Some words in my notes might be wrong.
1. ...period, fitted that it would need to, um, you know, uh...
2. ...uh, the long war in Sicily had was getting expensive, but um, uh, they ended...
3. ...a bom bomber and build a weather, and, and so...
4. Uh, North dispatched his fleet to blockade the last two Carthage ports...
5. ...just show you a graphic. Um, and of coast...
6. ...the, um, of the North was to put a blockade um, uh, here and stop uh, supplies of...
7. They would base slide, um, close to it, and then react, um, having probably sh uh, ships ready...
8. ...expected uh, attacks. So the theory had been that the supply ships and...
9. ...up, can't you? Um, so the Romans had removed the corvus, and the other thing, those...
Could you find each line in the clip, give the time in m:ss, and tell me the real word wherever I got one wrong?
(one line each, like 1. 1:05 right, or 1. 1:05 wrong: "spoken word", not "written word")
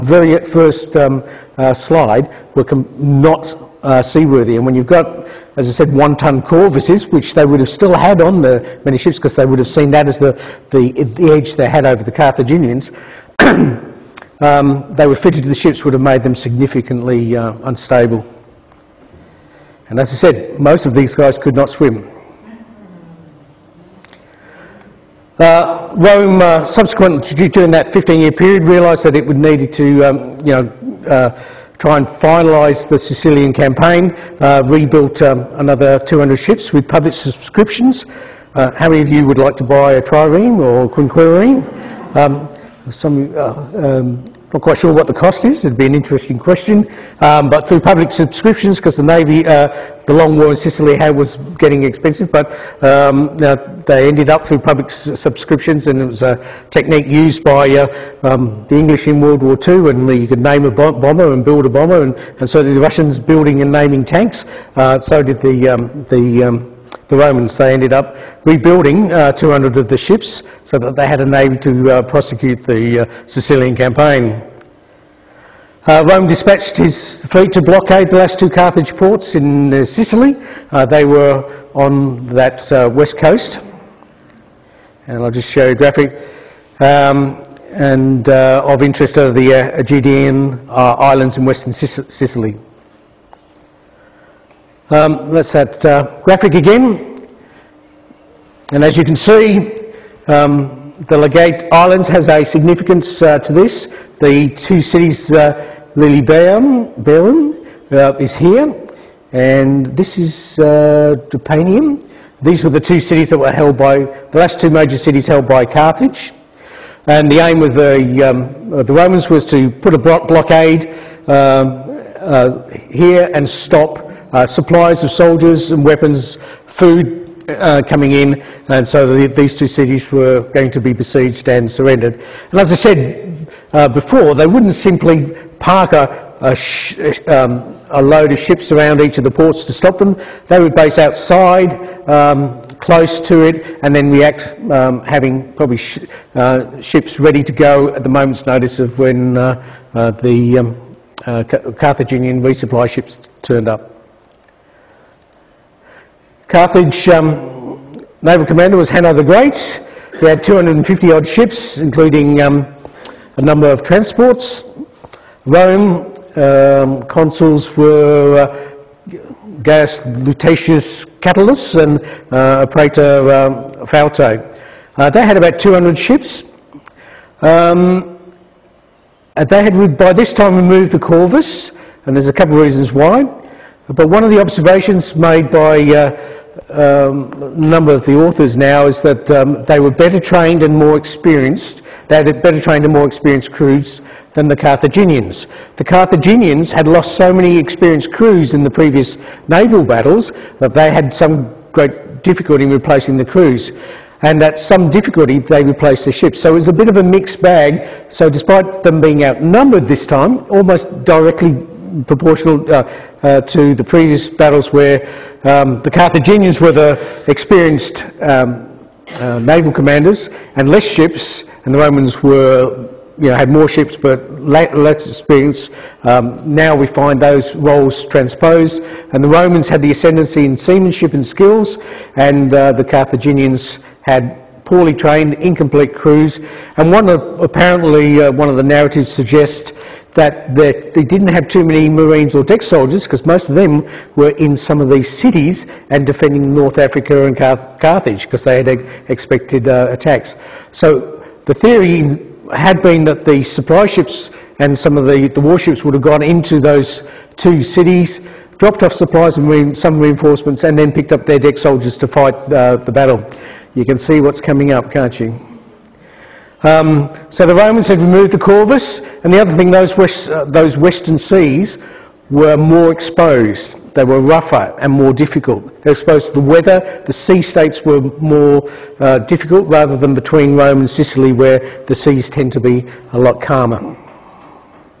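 1. 0:28 wrong: "realised", not "fitted"
2. 0:49 right
3. 1:00 wrong: "bomber", not "weather"
4. 1:15 wrong: "Rome", not "North"
5. 1:25 wrong: "interest", not "coast"
6. 1:57 wrong: "Romans", not "North"
7. 2:20 wrong: "outside", not "slide"
8. 4:09 right
9. 4:24 right.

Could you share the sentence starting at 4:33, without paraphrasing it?
They were rougher and more difficult.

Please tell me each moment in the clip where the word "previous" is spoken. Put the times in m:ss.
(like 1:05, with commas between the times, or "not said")
3:18, 3:33.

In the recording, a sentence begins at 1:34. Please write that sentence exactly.
Um, that's that uh, graphic again.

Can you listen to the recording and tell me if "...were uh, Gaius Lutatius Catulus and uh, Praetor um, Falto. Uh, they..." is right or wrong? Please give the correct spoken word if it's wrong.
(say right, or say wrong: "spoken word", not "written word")
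right.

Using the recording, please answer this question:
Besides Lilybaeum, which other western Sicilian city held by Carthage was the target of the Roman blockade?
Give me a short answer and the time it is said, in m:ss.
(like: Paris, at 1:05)
Drepanum, at 1:51.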